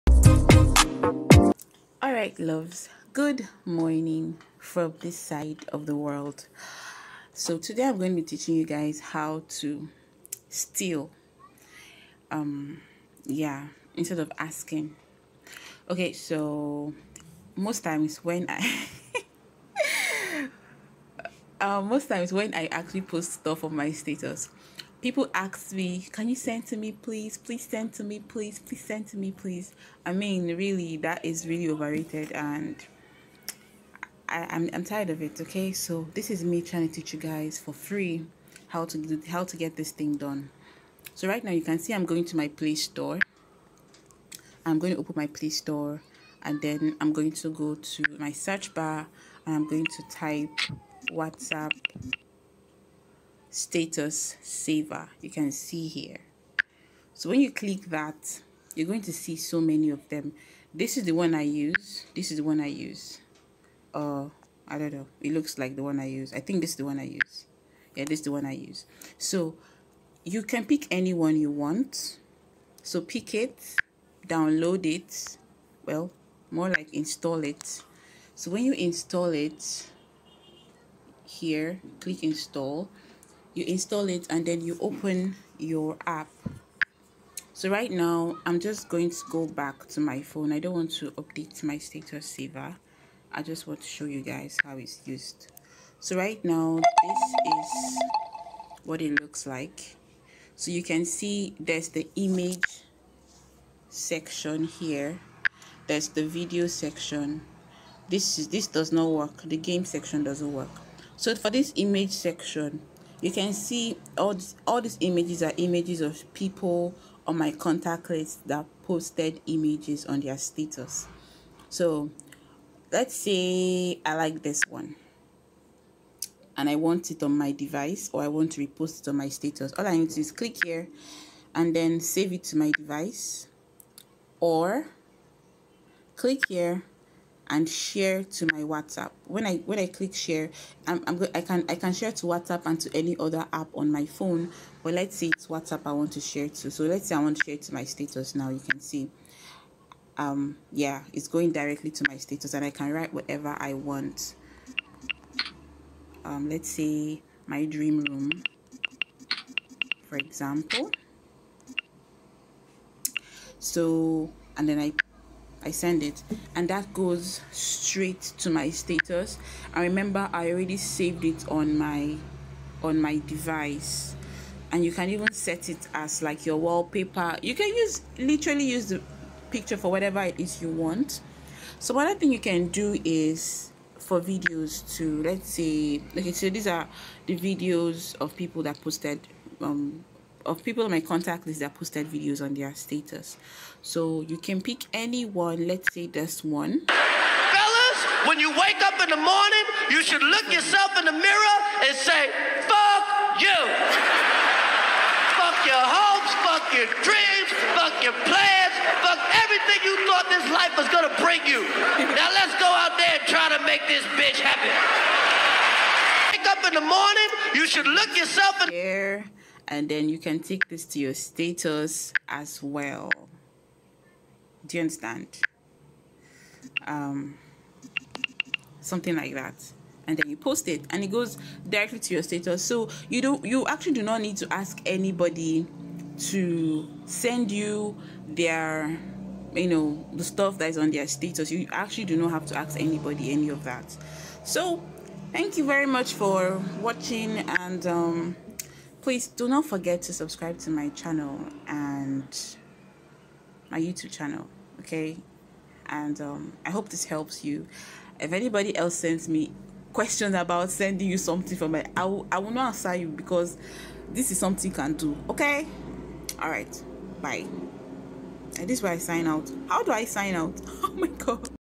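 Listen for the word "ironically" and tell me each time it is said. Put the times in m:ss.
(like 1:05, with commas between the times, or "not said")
not said.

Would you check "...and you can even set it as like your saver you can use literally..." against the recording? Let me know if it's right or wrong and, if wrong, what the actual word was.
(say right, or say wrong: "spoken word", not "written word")
wrong: "wallpaper", not "saver".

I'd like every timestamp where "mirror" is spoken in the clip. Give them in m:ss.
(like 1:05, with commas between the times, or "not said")
3:21, 3:38.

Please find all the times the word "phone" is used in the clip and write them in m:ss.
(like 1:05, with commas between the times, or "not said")
1:30, 2:24.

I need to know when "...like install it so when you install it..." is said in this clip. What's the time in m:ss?
1:16.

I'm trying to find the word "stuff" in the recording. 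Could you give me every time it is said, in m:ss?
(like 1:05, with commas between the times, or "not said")
0:23, 4:00.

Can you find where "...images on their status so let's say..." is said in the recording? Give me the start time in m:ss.
1:59.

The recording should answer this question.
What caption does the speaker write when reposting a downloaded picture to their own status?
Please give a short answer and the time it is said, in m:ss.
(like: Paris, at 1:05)
my dream room, at 2:37.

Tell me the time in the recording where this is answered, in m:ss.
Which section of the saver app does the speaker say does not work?
1:49.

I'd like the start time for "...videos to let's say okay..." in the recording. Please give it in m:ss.
3:04.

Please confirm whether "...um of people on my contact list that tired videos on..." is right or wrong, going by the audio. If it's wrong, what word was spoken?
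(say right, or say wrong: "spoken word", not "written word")
wrong: "posted", not "tired".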